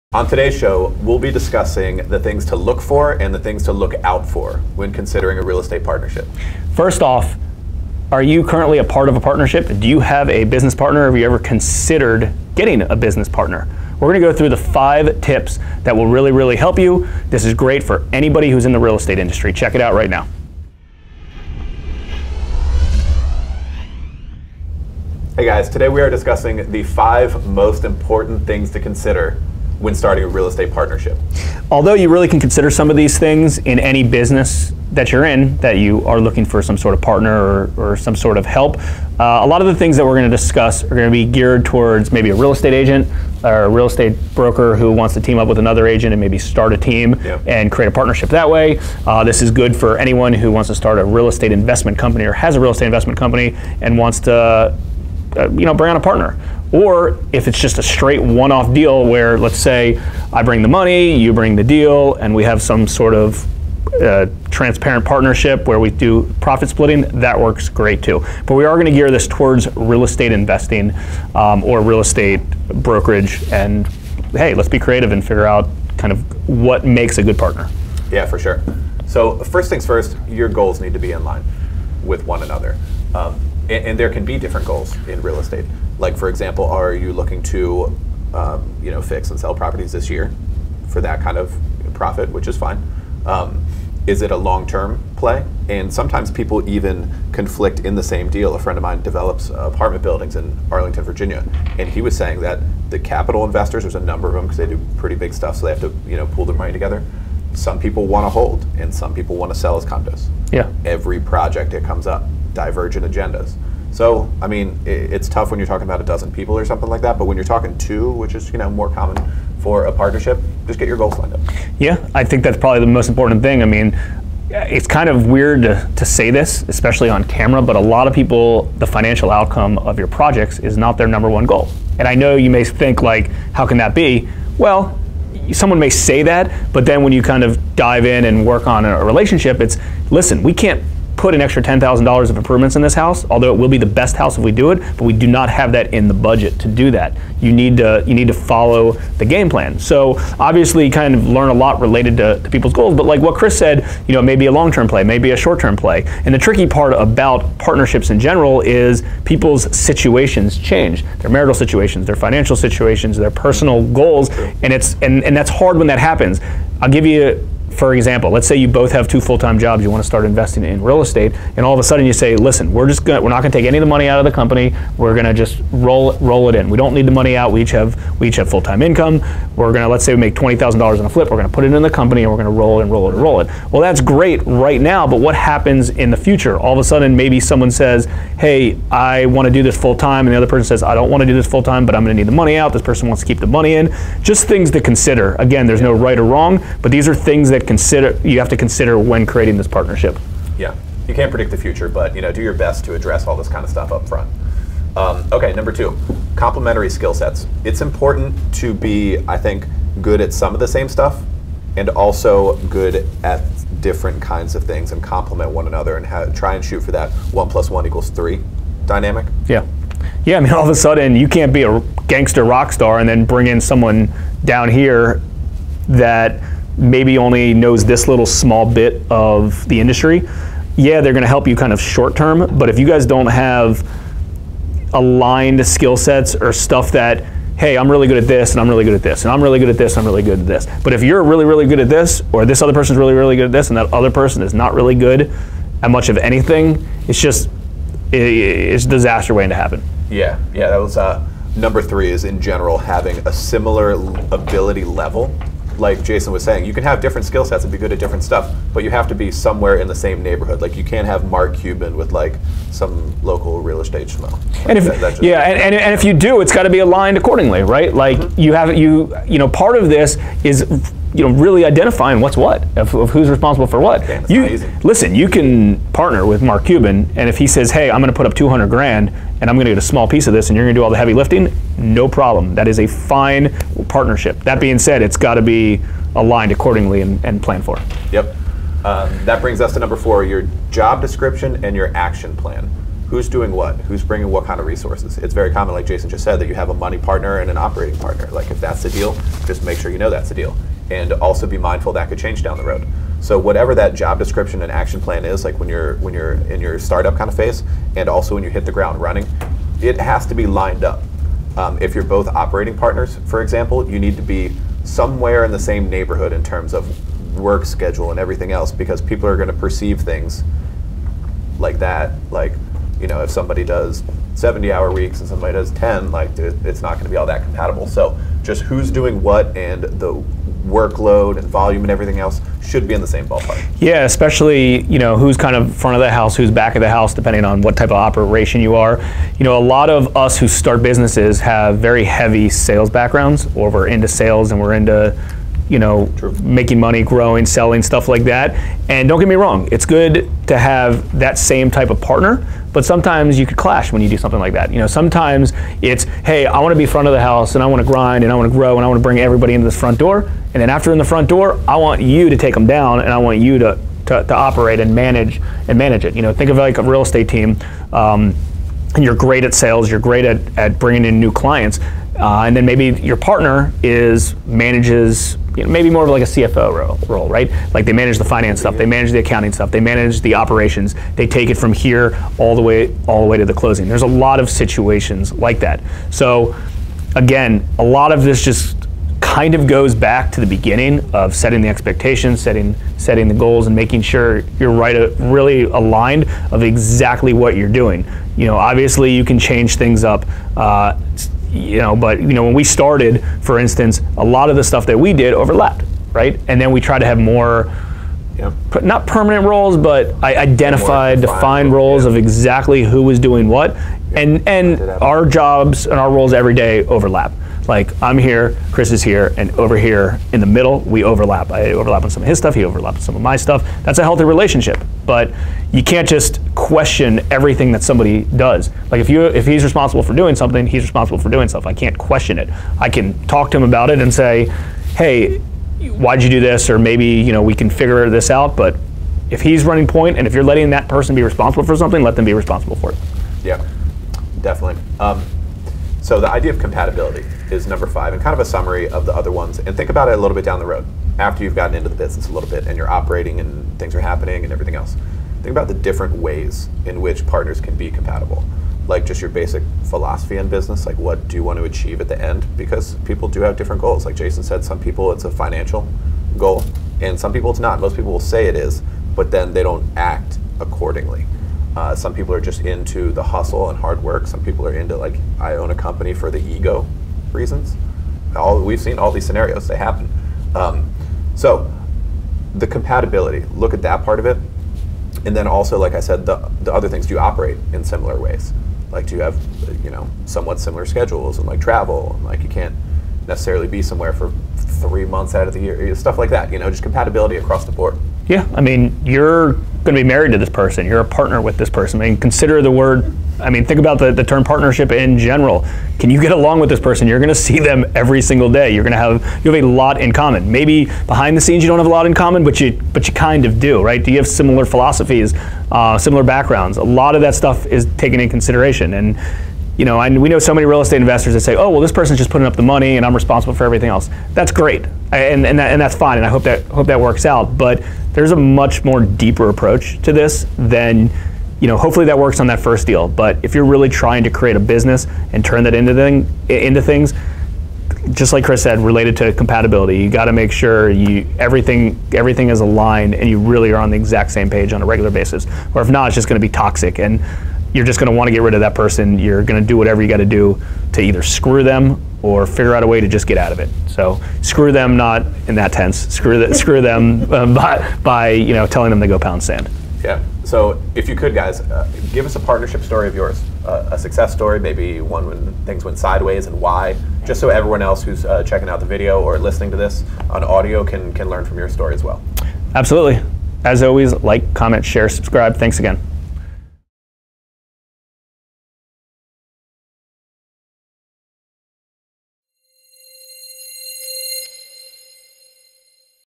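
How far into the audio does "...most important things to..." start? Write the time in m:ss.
0:27.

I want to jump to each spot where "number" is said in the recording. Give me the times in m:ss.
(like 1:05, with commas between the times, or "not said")
1:43, 2:11, 3:25, 4:11, 4:49, 7:27.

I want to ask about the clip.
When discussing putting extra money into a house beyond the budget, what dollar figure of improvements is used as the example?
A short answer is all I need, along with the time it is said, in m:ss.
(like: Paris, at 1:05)
$10,000, at 2:21.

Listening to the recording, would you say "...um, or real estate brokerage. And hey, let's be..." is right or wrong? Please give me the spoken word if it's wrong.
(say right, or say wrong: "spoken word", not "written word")
right.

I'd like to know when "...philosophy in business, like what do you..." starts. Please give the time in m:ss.
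7:39.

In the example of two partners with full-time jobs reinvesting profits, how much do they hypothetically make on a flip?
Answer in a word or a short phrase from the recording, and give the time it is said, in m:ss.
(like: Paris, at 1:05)
$20,000, at 3:00.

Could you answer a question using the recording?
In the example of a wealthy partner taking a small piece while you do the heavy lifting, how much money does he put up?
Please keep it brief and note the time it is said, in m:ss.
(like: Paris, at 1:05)
200 grand, at 4:38.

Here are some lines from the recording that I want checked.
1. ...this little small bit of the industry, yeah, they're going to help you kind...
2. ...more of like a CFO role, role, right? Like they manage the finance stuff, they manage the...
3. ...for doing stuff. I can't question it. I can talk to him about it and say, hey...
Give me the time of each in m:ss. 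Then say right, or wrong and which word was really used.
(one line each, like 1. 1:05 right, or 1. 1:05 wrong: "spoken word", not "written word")
1. 3:47 right
2. 6:15 right
3. 7:11 right.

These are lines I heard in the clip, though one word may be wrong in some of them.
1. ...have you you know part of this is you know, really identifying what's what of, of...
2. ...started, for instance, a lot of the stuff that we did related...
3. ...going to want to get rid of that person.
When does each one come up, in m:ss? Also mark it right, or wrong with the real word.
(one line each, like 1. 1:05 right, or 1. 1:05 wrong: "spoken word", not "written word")
1. 4:28 right
2. 6:42 wrong: "overlapped", not "related"
3. 9:07 right.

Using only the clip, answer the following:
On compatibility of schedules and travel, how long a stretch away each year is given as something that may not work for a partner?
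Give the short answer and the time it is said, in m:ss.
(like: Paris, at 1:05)
3 months, at 8:14.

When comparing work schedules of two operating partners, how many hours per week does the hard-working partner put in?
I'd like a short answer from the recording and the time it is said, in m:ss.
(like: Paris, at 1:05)
70, at 5:24.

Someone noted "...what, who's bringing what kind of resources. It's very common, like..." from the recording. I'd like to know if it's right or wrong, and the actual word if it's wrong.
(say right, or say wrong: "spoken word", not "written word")
right.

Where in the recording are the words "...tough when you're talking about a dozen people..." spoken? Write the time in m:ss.
1:55.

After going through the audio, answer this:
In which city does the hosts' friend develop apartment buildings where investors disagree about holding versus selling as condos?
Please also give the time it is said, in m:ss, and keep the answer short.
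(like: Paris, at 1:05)
Arlington, Virginia, at 1:40.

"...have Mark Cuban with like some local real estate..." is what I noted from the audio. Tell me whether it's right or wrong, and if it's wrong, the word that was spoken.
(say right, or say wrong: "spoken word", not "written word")
right.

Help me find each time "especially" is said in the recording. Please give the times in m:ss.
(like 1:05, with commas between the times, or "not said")
2:06, 5:34.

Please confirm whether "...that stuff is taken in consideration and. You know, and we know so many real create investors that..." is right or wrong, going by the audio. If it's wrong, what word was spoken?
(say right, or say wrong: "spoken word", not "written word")
wrong: "estate", not "create".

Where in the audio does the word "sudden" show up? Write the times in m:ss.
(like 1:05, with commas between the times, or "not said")
2:51, 3:06, 3:40.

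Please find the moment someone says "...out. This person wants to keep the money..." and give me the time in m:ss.
3:12.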